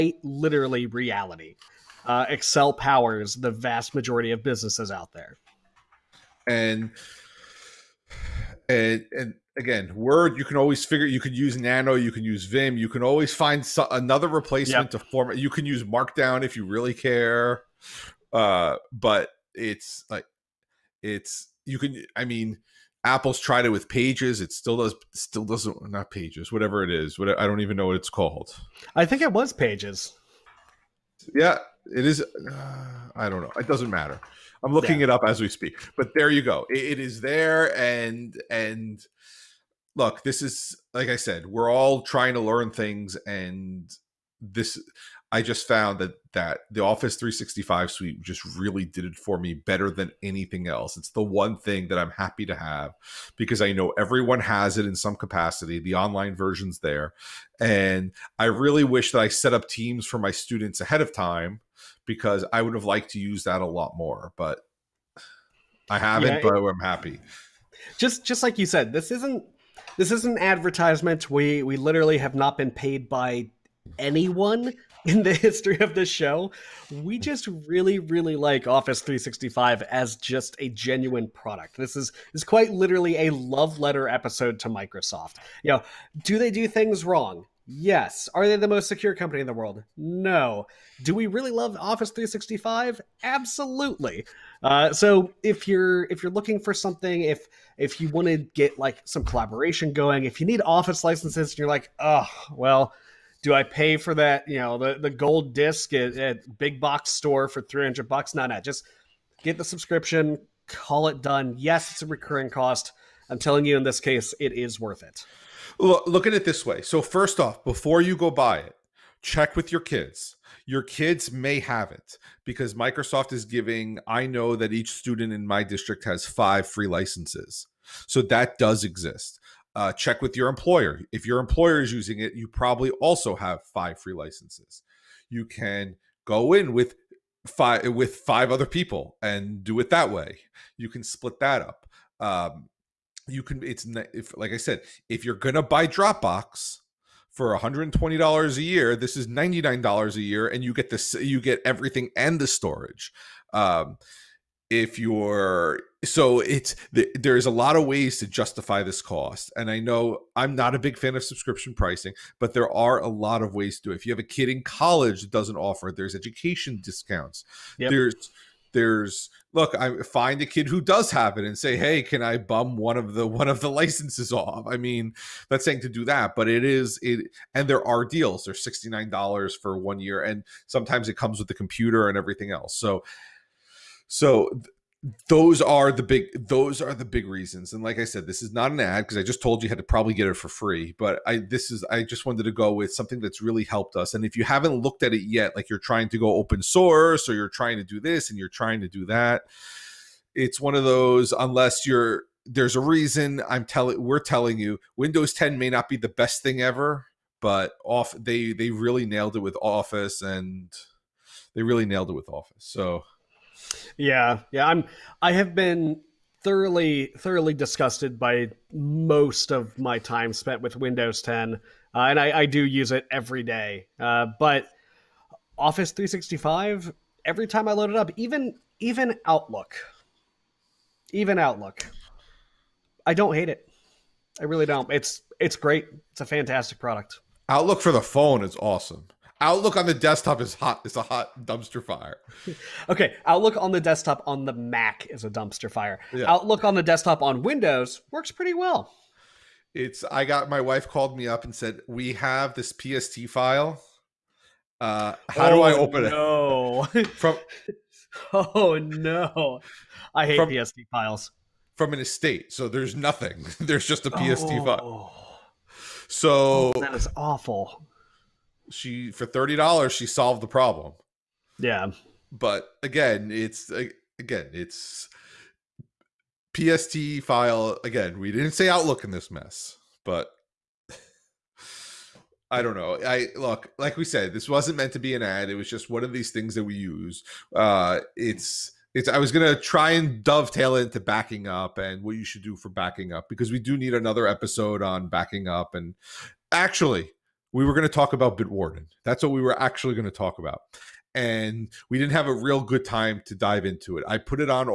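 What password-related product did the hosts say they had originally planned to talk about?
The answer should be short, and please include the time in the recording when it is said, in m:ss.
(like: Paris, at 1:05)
Bitwarden, at 4:58.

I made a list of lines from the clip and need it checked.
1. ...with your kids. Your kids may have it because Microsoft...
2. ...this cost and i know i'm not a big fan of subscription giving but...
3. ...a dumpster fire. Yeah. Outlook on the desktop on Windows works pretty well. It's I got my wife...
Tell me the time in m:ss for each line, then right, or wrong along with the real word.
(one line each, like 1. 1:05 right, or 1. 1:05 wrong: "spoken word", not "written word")
1. 1:59 right
2. 2:38 wrong: "pricing", not "giving"
3. 4:05 right.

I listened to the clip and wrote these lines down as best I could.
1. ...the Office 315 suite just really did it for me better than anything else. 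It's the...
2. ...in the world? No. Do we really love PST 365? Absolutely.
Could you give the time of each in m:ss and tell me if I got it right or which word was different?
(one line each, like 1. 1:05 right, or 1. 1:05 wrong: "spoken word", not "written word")
1. 0:46 wrong: "365", not "315"
2. 1:29 wrong: "Office", not "PST".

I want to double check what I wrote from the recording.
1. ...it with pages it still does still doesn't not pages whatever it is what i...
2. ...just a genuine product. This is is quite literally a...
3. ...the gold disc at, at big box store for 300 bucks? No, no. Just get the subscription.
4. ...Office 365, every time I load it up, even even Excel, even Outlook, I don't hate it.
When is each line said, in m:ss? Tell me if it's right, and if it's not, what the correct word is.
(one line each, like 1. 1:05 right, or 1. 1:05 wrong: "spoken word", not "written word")
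1. 0:23 right
2. 1:20 right
3. 1:44 right
4. 3:45 wrong: "Outlook", not "Excel".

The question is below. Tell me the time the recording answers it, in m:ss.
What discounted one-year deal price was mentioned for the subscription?
2:58.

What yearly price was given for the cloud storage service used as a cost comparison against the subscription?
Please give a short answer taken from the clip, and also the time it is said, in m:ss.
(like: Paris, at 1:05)
$120, at 2:27.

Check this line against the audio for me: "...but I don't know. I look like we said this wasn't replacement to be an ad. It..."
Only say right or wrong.
wrong.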